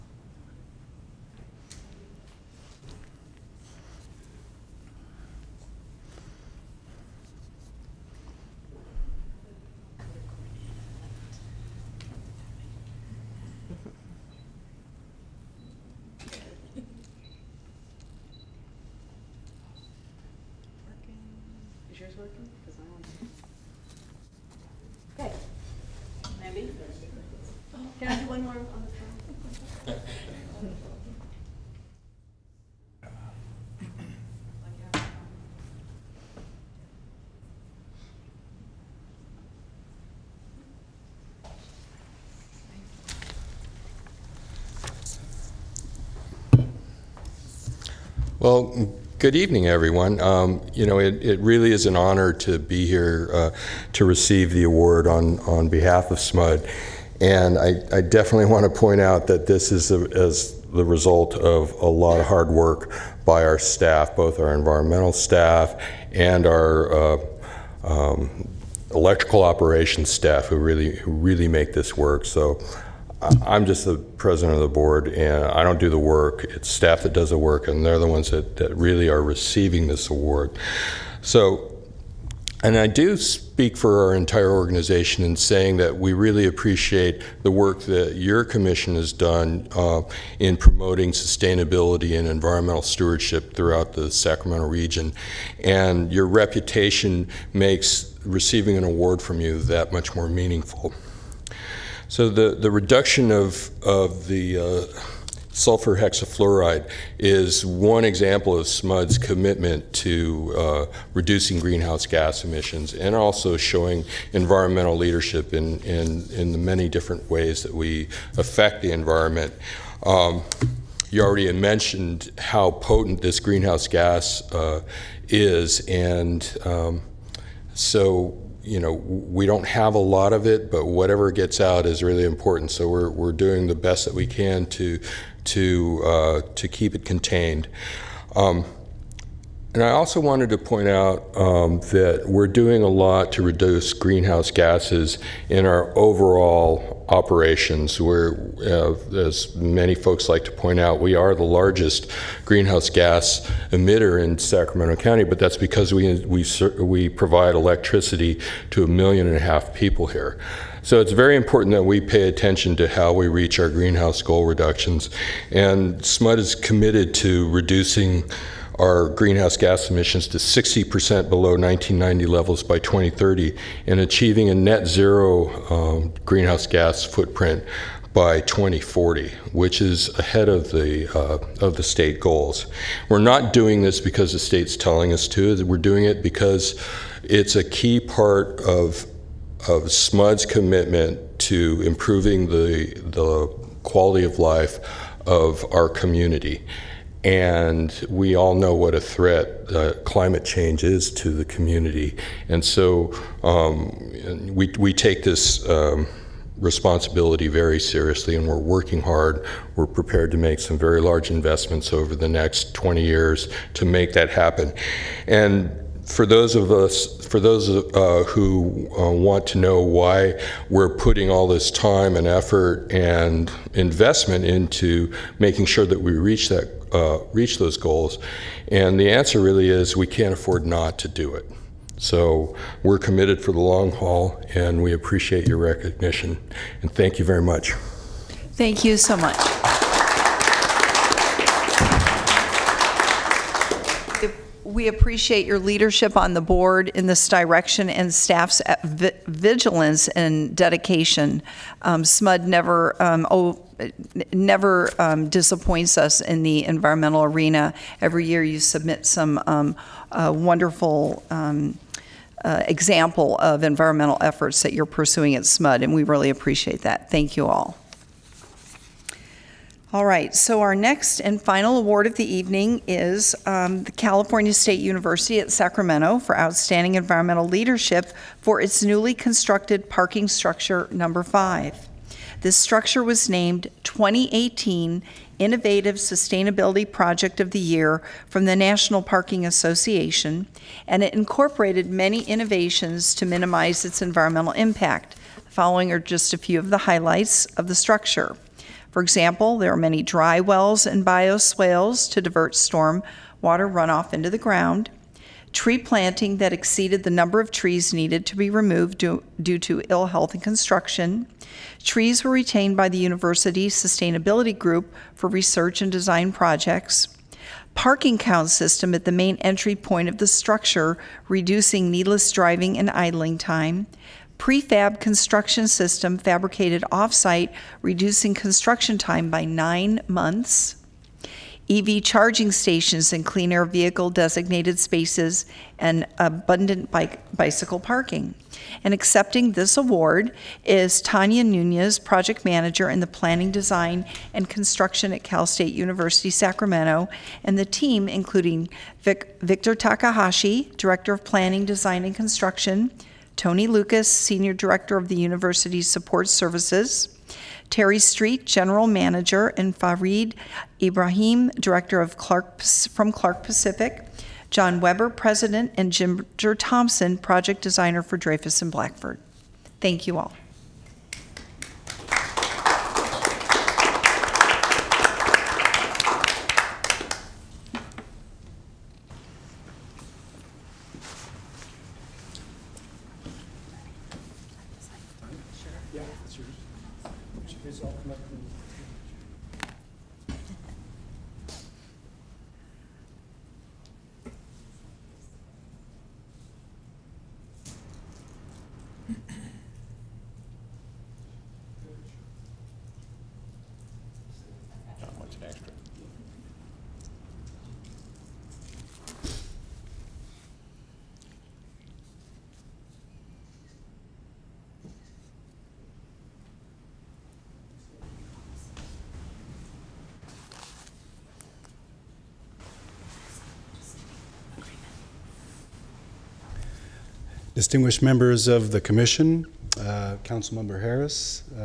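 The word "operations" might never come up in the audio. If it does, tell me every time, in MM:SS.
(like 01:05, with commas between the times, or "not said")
01:09, 02:27.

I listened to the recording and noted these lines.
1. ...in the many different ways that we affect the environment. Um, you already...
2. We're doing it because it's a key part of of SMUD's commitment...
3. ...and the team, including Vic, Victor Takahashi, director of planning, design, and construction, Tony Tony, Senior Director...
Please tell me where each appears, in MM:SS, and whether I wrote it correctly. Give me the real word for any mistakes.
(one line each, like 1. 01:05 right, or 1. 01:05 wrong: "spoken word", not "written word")
1. 01:56 right
2. 03:05 right
3. 05:47 wrong: "Lucas", not "Tony".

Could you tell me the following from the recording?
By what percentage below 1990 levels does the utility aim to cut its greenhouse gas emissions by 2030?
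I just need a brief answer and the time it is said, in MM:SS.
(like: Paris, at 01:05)
60%, at 02:50.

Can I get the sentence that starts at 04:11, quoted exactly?
Um, SMUD never um, oh, never um, disappoints us in the environmental arena.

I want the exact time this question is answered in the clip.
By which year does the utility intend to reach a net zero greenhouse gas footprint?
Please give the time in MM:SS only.
02:58.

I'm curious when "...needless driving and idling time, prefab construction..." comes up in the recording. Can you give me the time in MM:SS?
05:21.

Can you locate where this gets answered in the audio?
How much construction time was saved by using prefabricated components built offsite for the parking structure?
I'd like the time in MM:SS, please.
05:29.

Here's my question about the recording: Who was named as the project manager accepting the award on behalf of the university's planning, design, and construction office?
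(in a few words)
Tanya Nunez.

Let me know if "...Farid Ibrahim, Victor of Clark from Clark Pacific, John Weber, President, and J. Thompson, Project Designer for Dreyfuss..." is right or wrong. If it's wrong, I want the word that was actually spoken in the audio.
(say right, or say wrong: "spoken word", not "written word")
wrong: "Director", not "Victor".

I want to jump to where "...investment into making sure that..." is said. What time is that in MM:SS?
03:43.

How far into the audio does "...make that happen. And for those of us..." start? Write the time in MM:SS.
03:33.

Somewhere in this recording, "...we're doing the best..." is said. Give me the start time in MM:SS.
02:13.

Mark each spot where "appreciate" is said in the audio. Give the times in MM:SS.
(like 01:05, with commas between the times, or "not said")
01:26, 03:54, 04:04, 04:26.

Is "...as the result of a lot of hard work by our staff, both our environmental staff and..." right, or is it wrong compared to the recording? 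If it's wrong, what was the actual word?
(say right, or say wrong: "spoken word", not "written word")
right.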